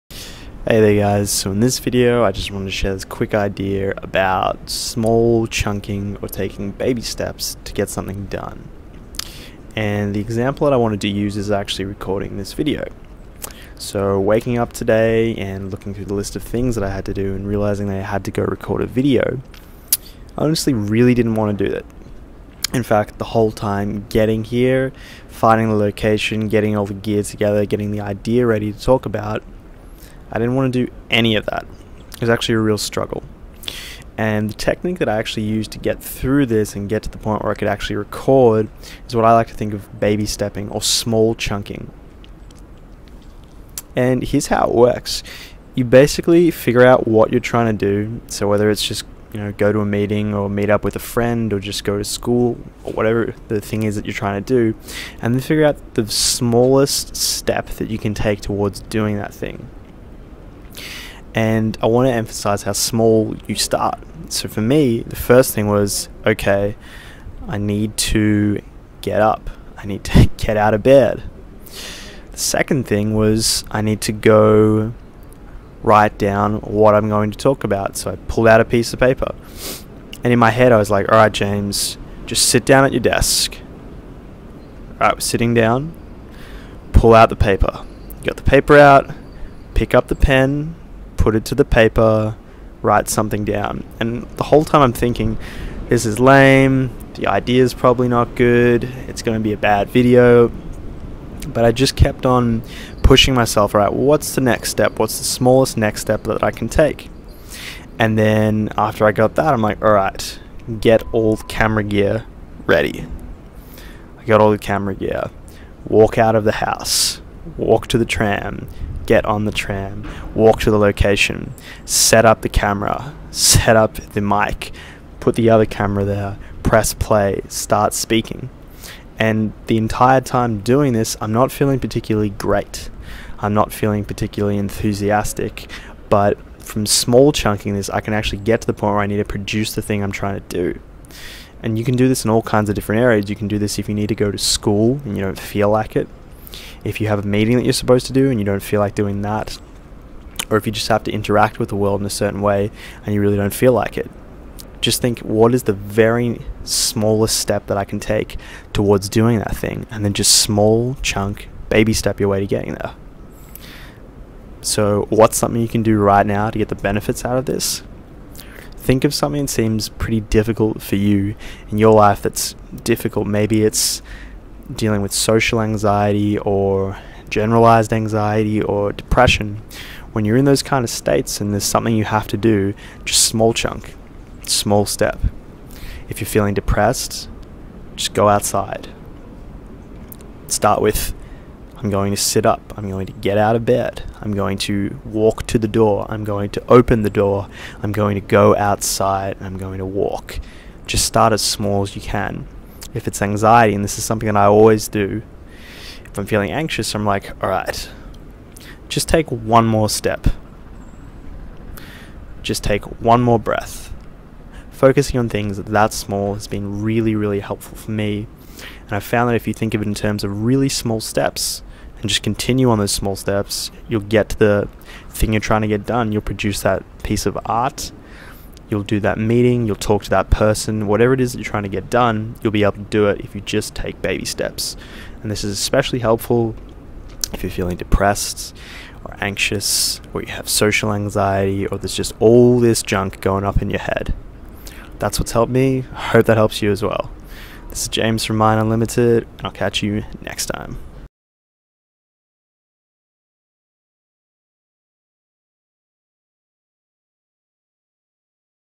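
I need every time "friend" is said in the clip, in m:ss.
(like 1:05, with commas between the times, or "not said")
0:50.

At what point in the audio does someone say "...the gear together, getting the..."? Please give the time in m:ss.
0:26.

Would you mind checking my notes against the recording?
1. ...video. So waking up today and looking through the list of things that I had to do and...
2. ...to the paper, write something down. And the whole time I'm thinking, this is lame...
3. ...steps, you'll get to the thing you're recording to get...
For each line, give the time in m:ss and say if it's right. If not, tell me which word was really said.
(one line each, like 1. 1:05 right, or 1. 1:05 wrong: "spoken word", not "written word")
1. 0:12 right
2. 1:31 right
3. 3:43 wrong: "trying", not "recording".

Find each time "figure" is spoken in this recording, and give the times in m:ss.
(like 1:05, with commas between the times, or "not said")
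0:46, 0:55.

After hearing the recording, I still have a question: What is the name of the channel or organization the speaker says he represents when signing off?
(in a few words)
Mind Unlimited.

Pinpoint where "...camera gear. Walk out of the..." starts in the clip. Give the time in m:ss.
1:54.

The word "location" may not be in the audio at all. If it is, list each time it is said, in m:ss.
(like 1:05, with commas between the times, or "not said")
0:25, 2:00.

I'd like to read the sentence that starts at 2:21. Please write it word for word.
And you can do this in all kinds of different areas.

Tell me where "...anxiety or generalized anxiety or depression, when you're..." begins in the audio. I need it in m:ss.
2:55.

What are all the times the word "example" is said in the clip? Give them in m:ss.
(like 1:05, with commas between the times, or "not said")
0:10.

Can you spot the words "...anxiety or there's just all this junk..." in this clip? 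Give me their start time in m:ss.
4:00.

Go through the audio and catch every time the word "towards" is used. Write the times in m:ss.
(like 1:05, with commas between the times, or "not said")
0:58, 2:38.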